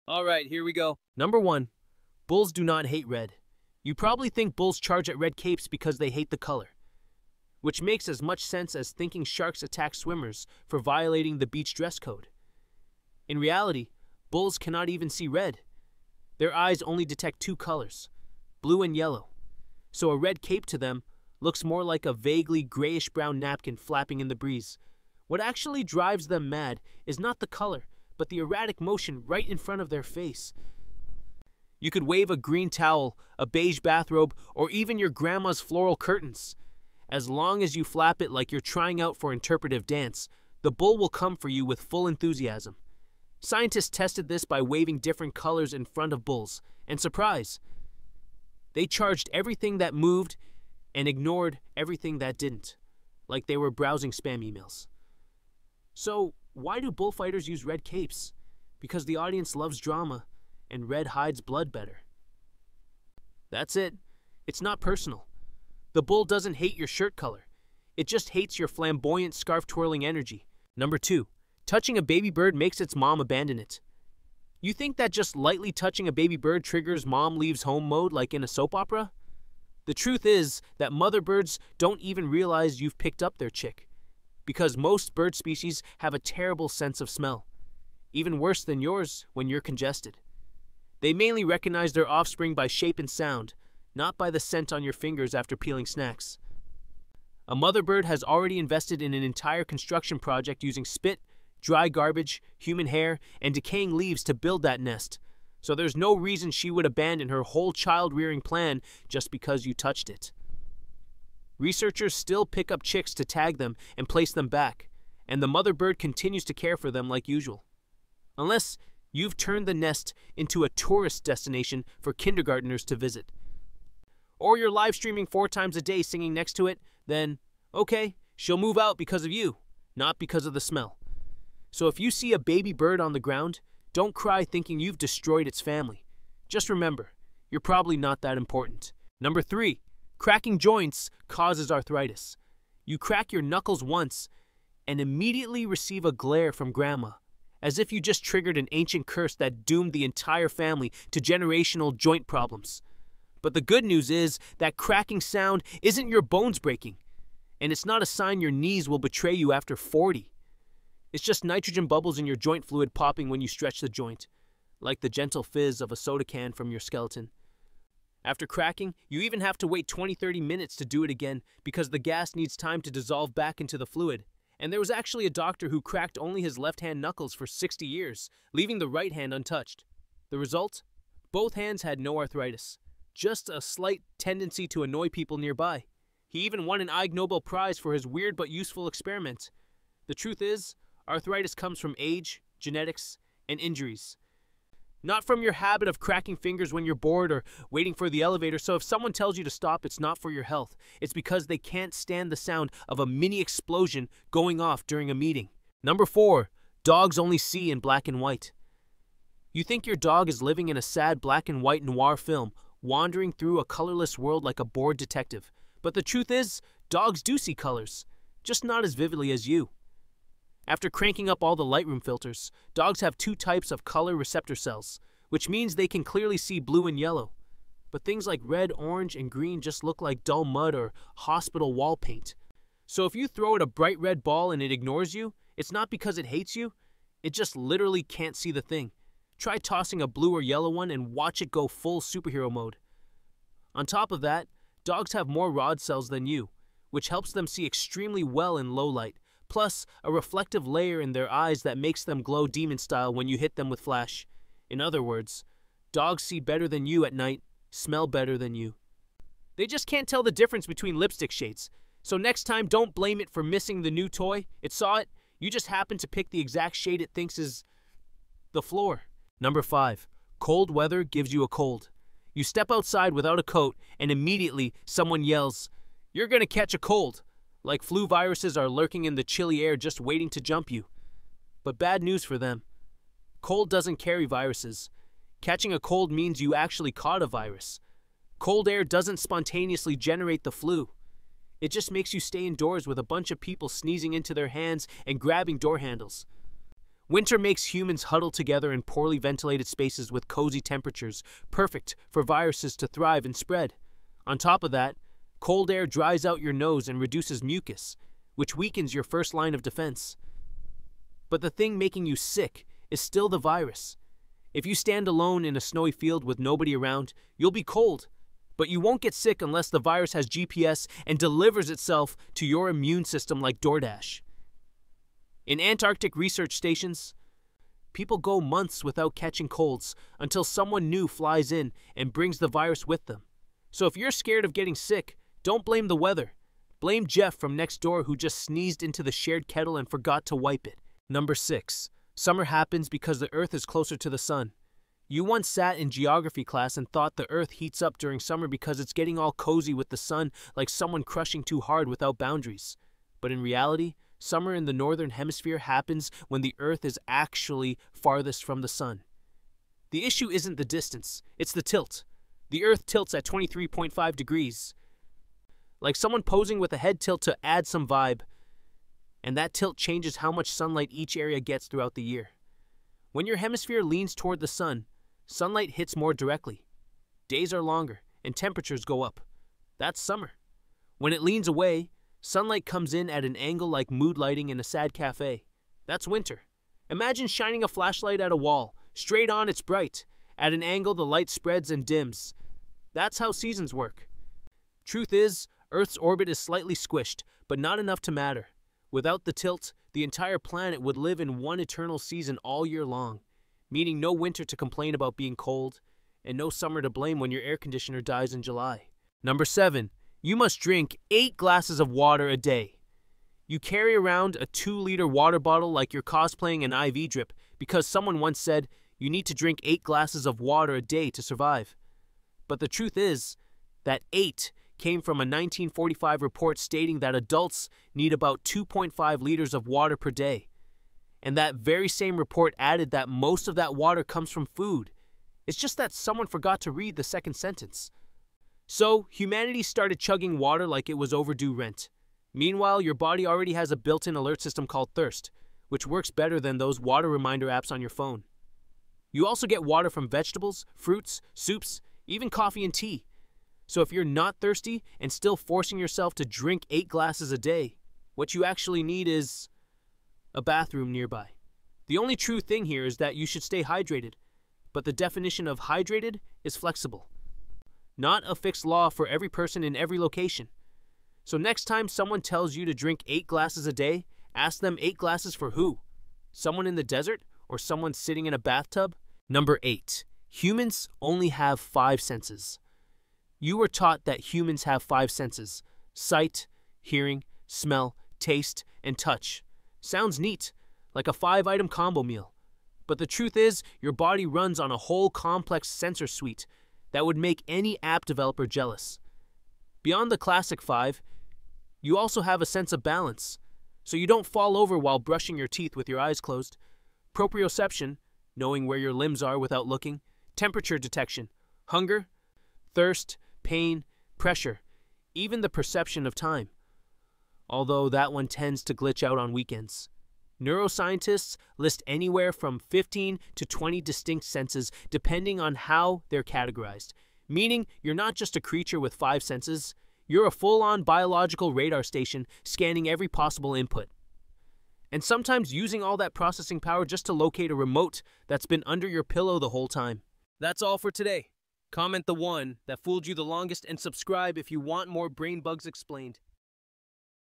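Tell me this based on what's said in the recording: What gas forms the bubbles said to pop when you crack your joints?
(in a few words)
nitrogen.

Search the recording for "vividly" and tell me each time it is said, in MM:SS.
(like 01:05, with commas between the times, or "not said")
03:38.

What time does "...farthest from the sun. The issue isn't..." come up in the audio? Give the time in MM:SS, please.
05:57.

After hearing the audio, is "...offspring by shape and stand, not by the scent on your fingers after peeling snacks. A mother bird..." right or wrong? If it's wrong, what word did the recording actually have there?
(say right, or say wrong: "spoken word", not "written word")
wrong: "sound", not "stand".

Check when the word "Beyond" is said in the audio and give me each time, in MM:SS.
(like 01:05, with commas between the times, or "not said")
08:19.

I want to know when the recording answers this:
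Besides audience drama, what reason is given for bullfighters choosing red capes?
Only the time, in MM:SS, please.
01:00.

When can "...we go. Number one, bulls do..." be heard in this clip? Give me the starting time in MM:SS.
00:00.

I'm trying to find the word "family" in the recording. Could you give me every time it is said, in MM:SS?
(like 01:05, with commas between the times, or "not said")
02:15, 02:30.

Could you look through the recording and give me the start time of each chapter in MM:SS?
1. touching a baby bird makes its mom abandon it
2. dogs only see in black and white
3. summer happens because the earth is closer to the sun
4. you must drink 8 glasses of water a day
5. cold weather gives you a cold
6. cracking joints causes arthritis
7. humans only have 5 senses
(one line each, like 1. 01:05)
1. 01:10
2. 03:25
3. 05:41
4. 06:49
5. 04:29
6. 02:19
7. 07:59.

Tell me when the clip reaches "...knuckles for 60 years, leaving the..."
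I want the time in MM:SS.
02:57.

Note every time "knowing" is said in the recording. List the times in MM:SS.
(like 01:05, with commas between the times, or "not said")
08:28.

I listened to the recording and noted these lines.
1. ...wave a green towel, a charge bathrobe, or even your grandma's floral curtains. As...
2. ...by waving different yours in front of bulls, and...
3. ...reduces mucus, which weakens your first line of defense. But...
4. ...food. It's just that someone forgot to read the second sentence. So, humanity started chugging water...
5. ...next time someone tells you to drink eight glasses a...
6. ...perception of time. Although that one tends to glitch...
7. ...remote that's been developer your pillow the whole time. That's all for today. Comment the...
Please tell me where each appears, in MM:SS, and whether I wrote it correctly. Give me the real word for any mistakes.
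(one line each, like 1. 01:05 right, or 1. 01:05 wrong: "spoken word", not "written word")
1. 00:32 wrong: "beige", not "charge"
2. 00:44 wrong: "colors", not "yours"
3. 05:07 right
4. 07:14 right
5. 07:51 right
6. 08:35 right
7. 08:57 wrong: "under", not "developer".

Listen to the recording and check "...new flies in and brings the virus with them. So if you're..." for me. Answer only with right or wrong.
right.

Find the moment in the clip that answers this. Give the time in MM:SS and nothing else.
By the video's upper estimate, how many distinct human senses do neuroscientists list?
08:42.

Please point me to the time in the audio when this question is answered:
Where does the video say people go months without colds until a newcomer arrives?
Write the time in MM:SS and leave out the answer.
05:25.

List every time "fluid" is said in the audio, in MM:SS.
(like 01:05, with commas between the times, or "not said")
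02:42, 02:53.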